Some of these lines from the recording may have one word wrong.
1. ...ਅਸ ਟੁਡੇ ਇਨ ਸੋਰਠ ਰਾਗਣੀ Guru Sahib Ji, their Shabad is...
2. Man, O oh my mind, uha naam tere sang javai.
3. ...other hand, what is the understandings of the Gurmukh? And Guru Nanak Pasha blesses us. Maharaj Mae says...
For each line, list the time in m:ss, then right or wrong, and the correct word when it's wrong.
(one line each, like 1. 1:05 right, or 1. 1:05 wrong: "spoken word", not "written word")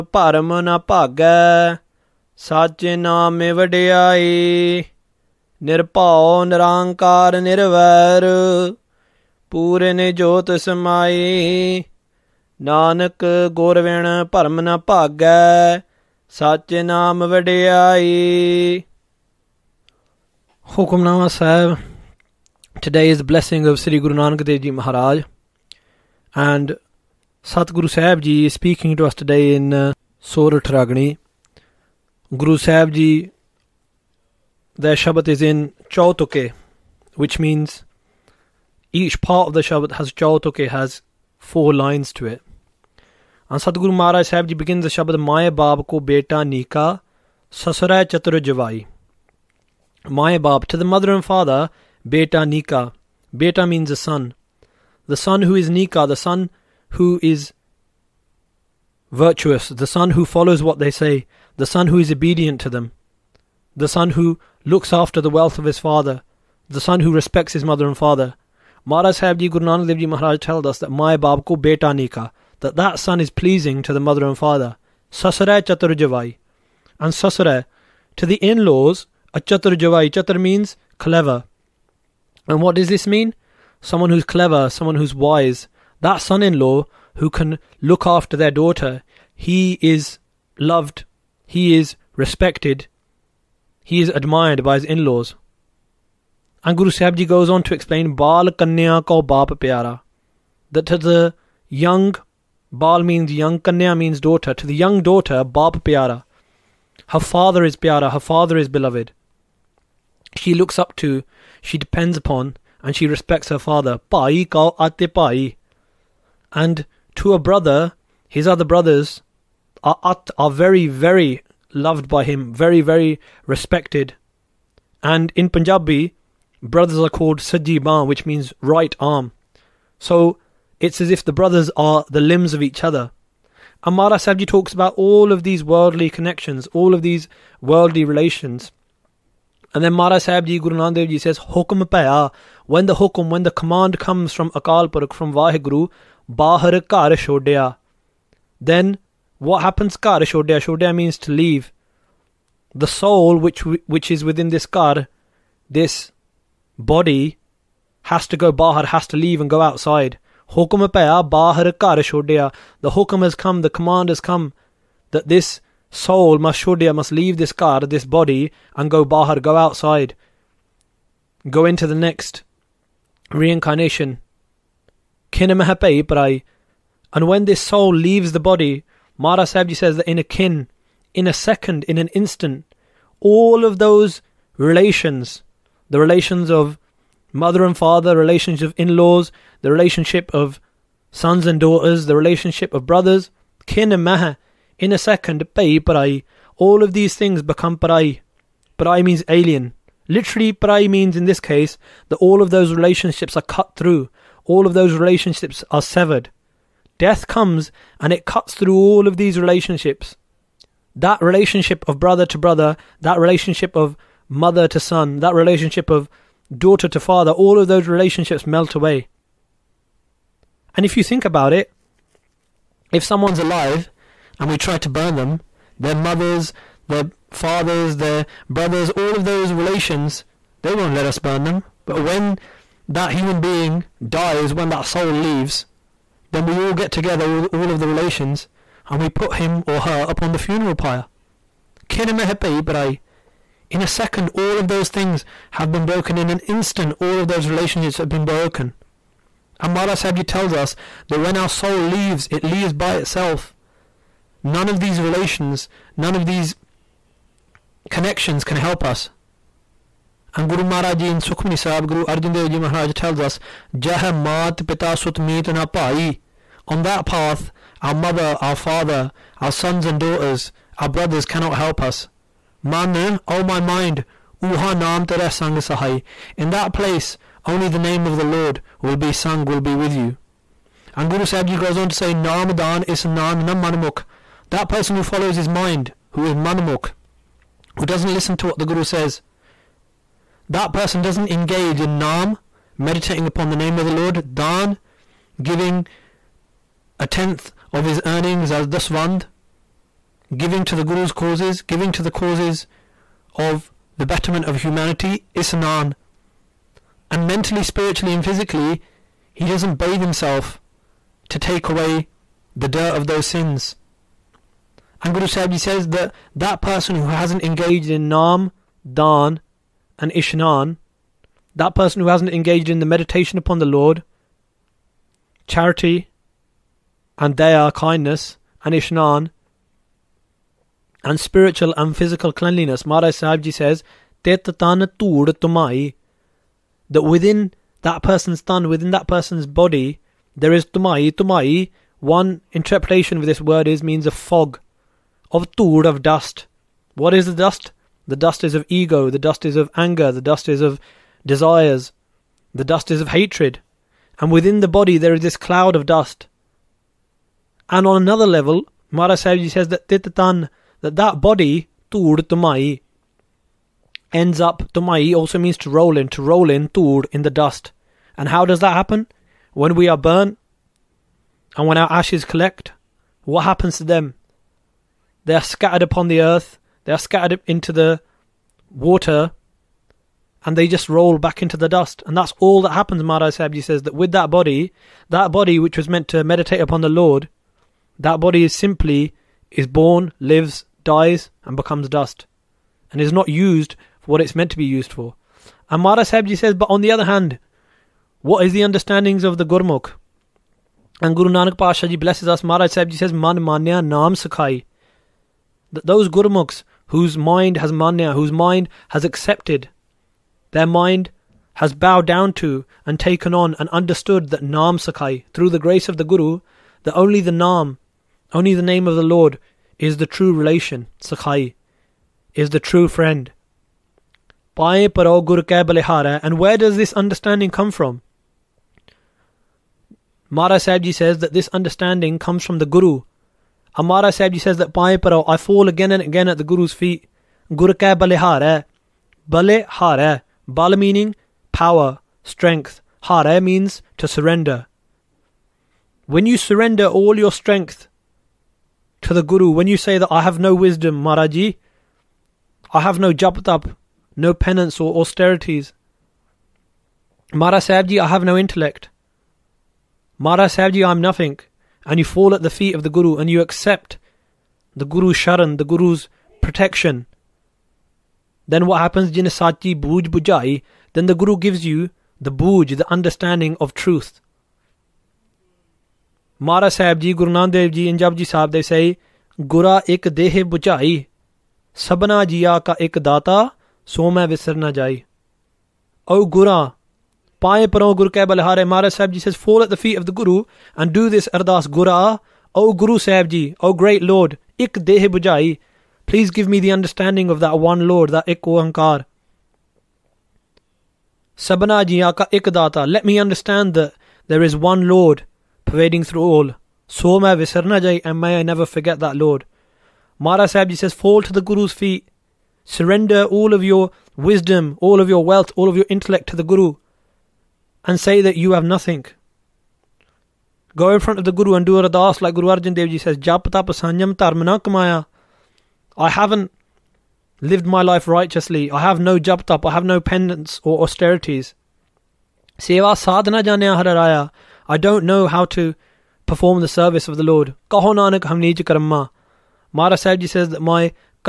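1. 0:29 right
2. 4:32 wrong: "sahai", not "javai"
3. 6:36 wrong: "Sahibji", not "Mae".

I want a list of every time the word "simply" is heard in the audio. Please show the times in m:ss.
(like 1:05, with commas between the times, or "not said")
6:28.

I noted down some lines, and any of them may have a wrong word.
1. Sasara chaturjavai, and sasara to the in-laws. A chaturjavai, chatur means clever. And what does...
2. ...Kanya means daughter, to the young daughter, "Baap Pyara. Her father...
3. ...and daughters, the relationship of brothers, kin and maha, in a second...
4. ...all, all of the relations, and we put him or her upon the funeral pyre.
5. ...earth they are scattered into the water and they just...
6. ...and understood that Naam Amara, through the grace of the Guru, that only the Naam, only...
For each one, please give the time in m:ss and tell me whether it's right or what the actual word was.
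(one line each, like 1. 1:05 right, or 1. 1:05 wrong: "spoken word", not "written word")
1. 1:15 right
2. 1:43 right
3. 3:11 right
4. 3:57 right
5. 6:16 right
6. 6:53 wrong: "Sakai", not "Amara".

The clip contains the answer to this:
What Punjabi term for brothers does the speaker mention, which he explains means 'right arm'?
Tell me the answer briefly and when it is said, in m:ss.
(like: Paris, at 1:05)
Sajjiban, at 2:07.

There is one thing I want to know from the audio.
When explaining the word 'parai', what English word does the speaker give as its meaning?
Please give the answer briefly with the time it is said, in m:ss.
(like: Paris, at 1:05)
alien, at 3:18.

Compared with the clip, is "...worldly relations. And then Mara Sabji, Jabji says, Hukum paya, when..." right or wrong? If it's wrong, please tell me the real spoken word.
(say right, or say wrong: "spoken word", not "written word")
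wrong: "Guru", not "Jabji".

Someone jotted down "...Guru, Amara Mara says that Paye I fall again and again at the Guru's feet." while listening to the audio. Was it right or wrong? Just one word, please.
wrong.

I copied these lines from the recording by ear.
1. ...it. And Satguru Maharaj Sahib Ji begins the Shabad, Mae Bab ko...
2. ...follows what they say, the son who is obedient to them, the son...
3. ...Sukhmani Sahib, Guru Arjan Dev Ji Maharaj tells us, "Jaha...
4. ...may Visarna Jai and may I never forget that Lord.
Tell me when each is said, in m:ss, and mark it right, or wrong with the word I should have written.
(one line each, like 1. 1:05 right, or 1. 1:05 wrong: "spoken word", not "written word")
1. 0:42 right
2. 1:00 right
3. 4:21 right
4. 8:27 right.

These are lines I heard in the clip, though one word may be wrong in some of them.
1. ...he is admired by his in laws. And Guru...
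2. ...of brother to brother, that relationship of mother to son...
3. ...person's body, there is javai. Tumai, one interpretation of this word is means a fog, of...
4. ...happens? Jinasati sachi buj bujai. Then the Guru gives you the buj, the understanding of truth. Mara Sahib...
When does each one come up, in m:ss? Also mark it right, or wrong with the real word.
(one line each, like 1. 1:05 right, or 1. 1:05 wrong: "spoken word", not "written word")
1. 1:33 right
2. 3:31 right
3. 5:39 wrong: "tumai", not "javai"
4. 7:48 right.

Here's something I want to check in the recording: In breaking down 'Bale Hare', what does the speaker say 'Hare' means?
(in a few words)
to surrender.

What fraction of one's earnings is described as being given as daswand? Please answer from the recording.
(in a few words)
a tenth.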